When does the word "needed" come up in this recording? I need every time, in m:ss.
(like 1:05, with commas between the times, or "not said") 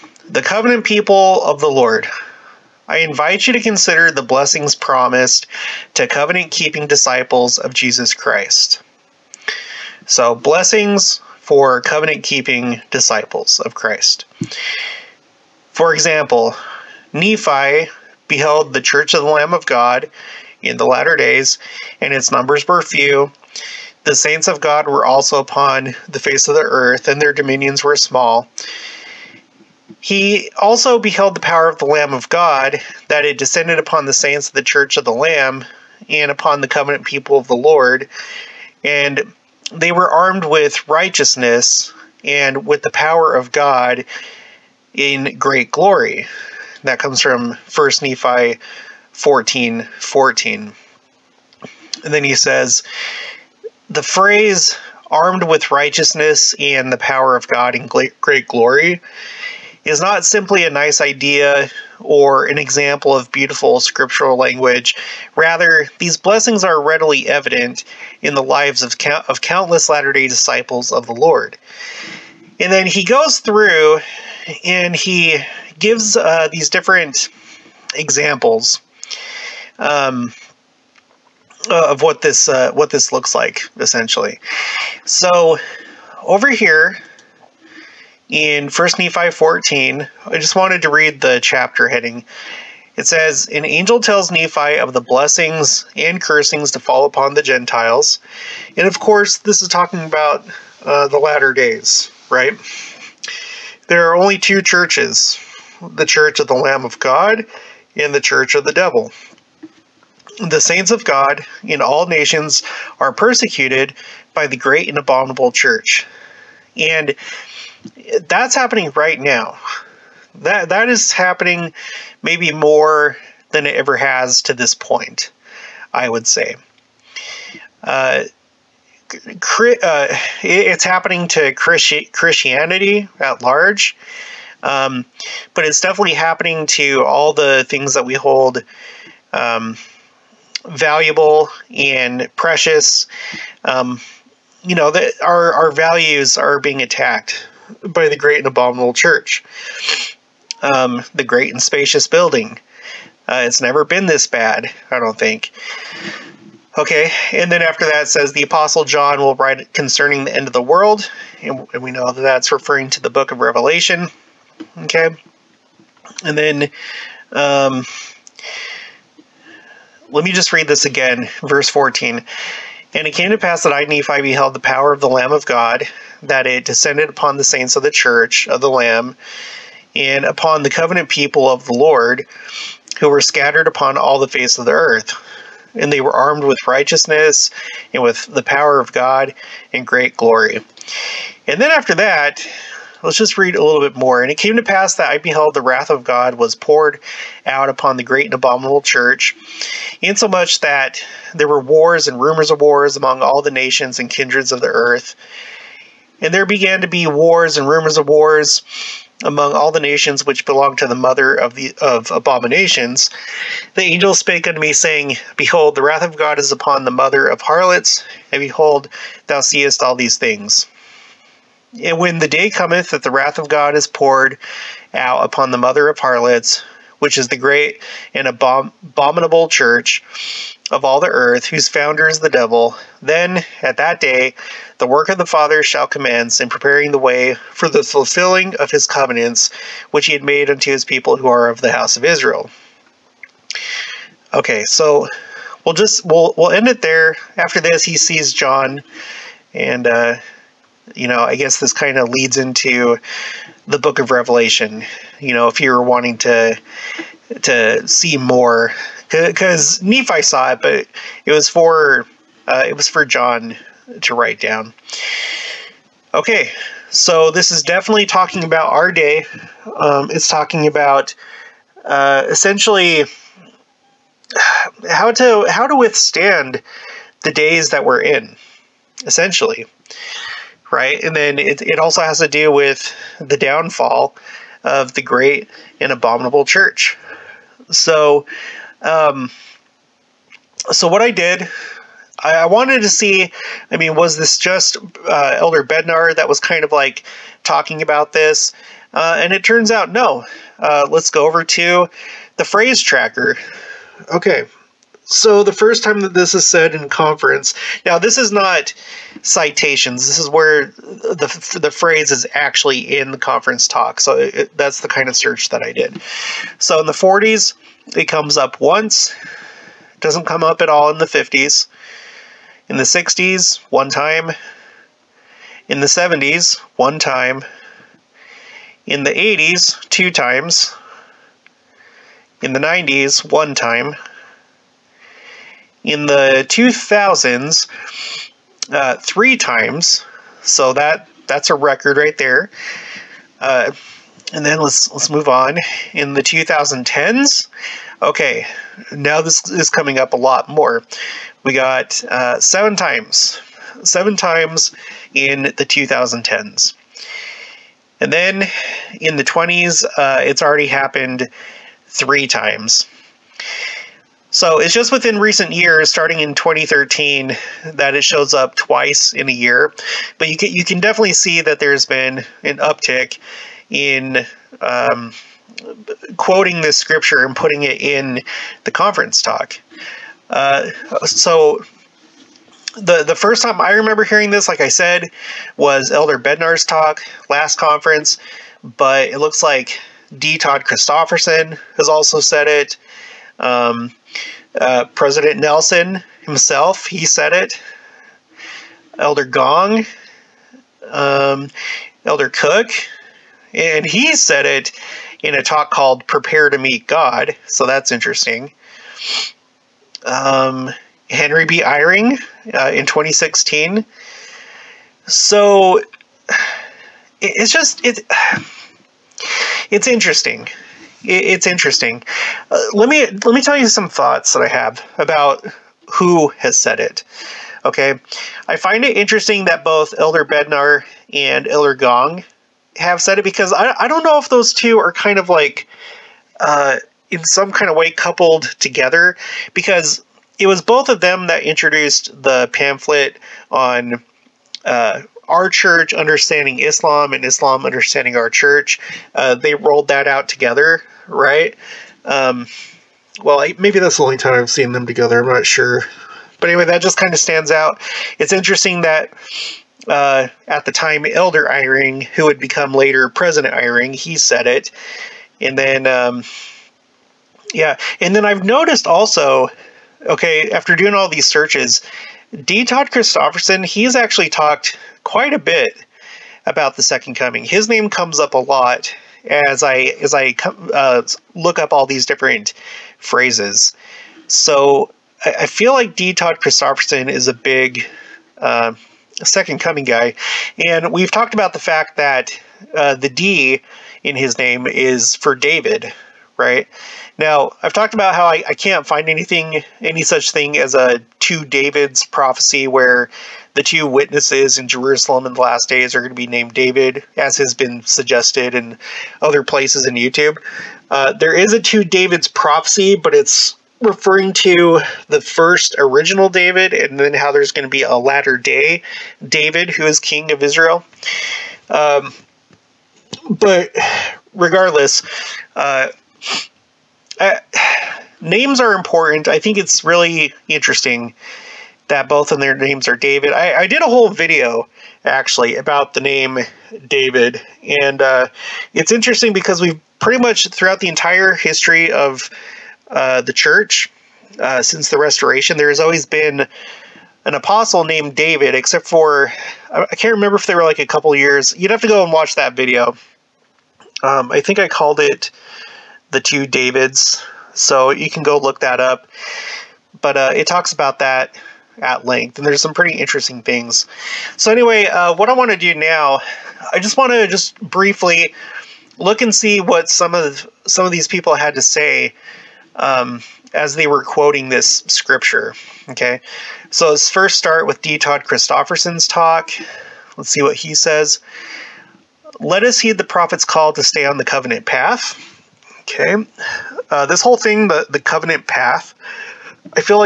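not said.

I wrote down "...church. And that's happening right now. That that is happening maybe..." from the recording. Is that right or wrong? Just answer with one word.
right.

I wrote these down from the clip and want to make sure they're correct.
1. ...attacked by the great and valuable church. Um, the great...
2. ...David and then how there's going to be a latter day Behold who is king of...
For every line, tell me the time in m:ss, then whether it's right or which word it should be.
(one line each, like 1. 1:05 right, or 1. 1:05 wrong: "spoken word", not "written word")
1. 2:26 wrong: "abominable", not "valuable"
2. 8:36 wrong: "David", not "Behold".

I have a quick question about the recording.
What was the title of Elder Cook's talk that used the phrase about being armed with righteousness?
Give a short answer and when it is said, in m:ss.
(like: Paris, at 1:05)
Prepare to Meet God, at 6:46.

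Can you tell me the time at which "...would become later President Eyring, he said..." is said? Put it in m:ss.
7:42.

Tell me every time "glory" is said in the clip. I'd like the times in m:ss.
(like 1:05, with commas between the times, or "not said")
0:45, 0:58, 3:10.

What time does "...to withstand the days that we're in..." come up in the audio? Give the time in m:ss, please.
4:35.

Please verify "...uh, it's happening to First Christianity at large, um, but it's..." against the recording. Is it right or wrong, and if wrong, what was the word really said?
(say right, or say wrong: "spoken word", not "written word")
wrong: "Christi", not "First".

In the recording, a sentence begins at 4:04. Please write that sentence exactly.
Okay, so we'll just we'll we'll end it there.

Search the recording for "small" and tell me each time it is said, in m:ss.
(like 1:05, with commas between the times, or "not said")
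0:27.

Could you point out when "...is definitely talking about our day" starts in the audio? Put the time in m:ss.
4:27.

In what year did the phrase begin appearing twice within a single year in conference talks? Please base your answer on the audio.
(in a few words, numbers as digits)
2013.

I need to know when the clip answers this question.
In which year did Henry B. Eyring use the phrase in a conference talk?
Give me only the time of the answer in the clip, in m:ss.
6:52.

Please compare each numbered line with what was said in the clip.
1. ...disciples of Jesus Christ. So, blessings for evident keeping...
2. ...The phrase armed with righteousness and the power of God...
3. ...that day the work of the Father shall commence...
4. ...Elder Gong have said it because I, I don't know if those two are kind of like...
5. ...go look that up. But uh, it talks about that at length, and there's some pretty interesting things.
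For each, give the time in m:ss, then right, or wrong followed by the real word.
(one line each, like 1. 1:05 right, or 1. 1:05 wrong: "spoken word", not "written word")
1. 0:06 wrong: "covenant", not "evident"
2. 0:53 right
3. 3:53 right
4. 7:11 right
5. 9:18 right.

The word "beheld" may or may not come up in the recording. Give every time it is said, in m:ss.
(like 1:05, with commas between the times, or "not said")
0:18, 0:30, 2:54, 3:15.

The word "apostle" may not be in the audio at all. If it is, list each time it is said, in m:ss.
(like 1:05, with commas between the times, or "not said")
2:38, 9:07.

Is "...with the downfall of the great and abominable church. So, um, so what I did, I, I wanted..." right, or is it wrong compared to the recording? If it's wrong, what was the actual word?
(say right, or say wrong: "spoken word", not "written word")
right.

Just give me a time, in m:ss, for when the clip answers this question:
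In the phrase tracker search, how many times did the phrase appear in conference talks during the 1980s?
5:29.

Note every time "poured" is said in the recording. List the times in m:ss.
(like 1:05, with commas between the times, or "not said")
3:16, 3:43.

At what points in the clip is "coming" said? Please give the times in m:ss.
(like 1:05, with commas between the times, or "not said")
5:49, 7:57, 8:09.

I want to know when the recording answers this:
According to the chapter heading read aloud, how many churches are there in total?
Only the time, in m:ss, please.
1:44.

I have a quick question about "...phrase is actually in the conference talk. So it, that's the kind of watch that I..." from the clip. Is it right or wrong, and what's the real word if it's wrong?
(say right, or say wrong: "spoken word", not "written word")
wrong: "search", not "watch".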